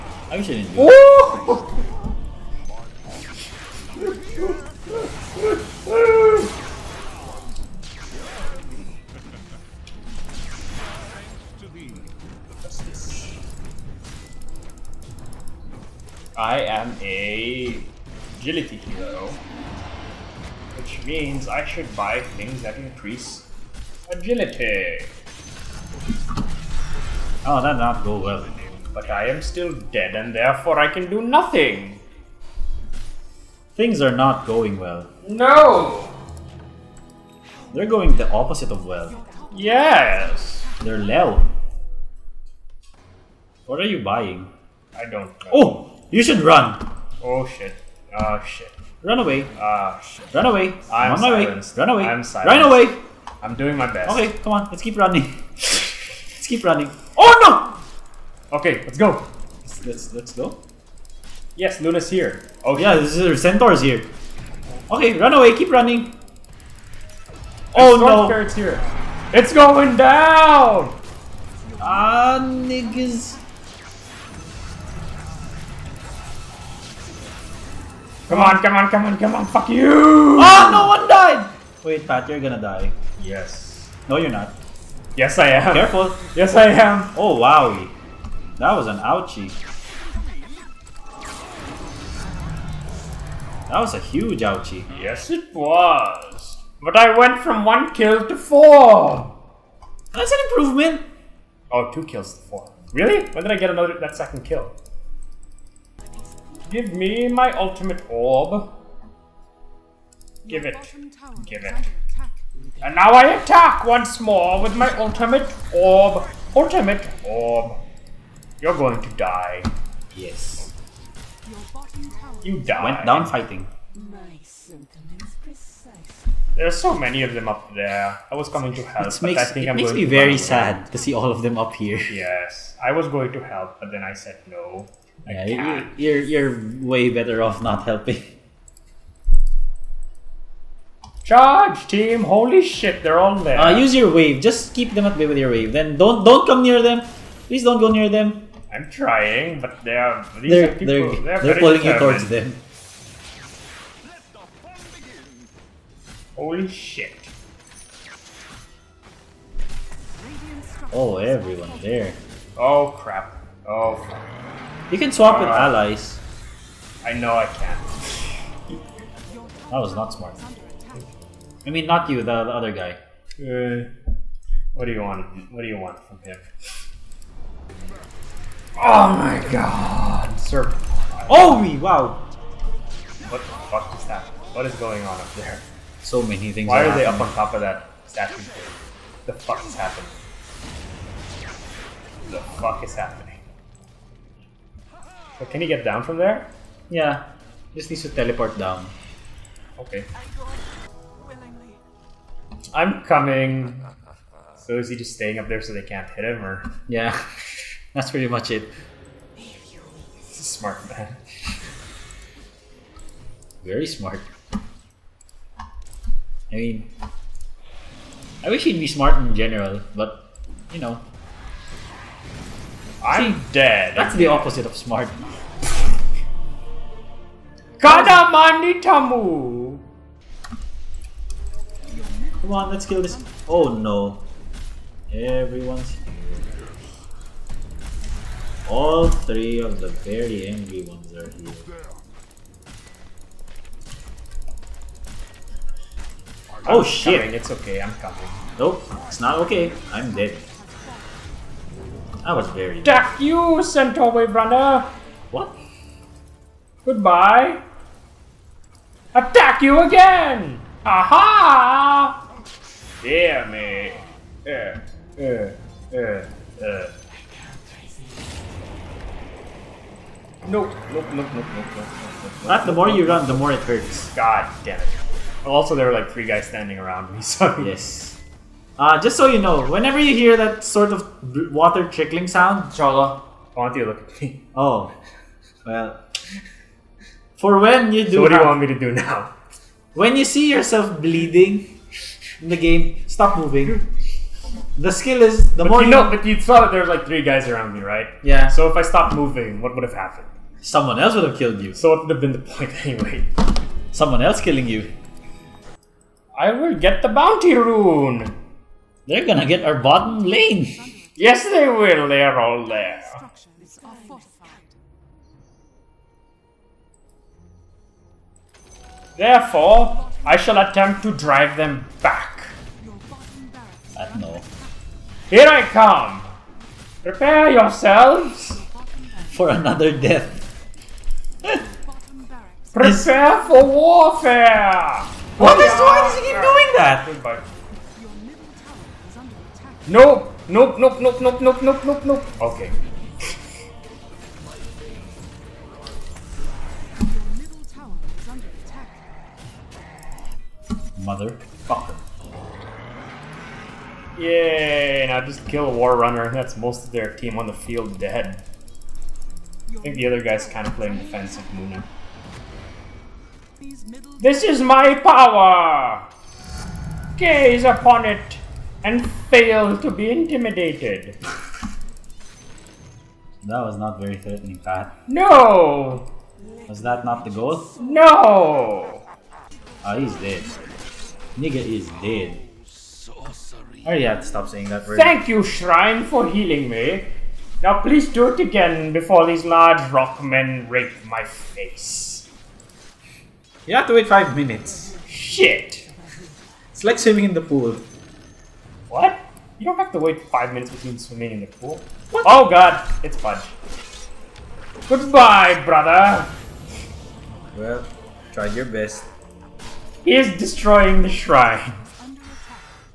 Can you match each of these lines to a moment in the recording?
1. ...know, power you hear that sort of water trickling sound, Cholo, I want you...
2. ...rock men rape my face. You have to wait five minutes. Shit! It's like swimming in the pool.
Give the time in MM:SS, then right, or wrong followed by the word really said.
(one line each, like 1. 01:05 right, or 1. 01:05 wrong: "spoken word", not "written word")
1. 04:39 wrong: "whenever", not "power"
2. 06:29 right.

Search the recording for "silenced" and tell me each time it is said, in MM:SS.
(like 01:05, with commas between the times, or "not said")
00:52.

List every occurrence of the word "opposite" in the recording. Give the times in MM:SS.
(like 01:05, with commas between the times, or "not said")
00:38, 03:44.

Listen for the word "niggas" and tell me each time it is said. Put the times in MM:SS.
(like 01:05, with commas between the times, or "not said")
01:12, 06:21.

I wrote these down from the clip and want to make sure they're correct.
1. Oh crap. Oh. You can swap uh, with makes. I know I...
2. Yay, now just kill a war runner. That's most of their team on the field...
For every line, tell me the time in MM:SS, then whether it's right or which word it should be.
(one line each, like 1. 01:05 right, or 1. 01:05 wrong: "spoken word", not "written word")
1. 02:42 wrong: "allies", not "makes"
2. 05:54 right.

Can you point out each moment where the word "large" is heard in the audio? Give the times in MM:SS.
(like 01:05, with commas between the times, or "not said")
06:29.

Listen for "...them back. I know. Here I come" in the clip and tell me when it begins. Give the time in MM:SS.
05:21.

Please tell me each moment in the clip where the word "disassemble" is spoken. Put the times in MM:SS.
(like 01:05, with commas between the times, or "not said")
not said.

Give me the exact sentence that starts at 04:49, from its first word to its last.
When you see yourself bleeding in the game, stop moving.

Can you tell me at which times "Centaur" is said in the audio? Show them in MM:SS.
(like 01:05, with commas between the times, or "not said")
01:03, 04:13.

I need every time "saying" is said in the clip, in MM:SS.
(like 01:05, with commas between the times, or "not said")
06:24.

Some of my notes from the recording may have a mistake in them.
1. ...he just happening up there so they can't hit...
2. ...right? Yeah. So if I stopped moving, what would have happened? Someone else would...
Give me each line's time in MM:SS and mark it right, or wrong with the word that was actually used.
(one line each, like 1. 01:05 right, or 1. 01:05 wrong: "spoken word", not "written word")
1. 03:24 wrong: "staying", not "happening"
2. 04:57 right.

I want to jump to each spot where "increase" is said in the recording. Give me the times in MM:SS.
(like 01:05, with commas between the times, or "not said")
00:22.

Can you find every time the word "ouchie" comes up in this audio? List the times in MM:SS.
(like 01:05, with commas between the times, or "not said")
01:28, 01:34.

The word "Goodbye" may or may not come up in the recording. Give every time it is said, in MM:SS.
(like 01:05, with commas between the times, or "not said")
04:16, 06:44.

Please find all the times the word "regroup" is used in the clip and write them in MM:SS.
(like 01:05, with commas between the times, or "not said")
not said.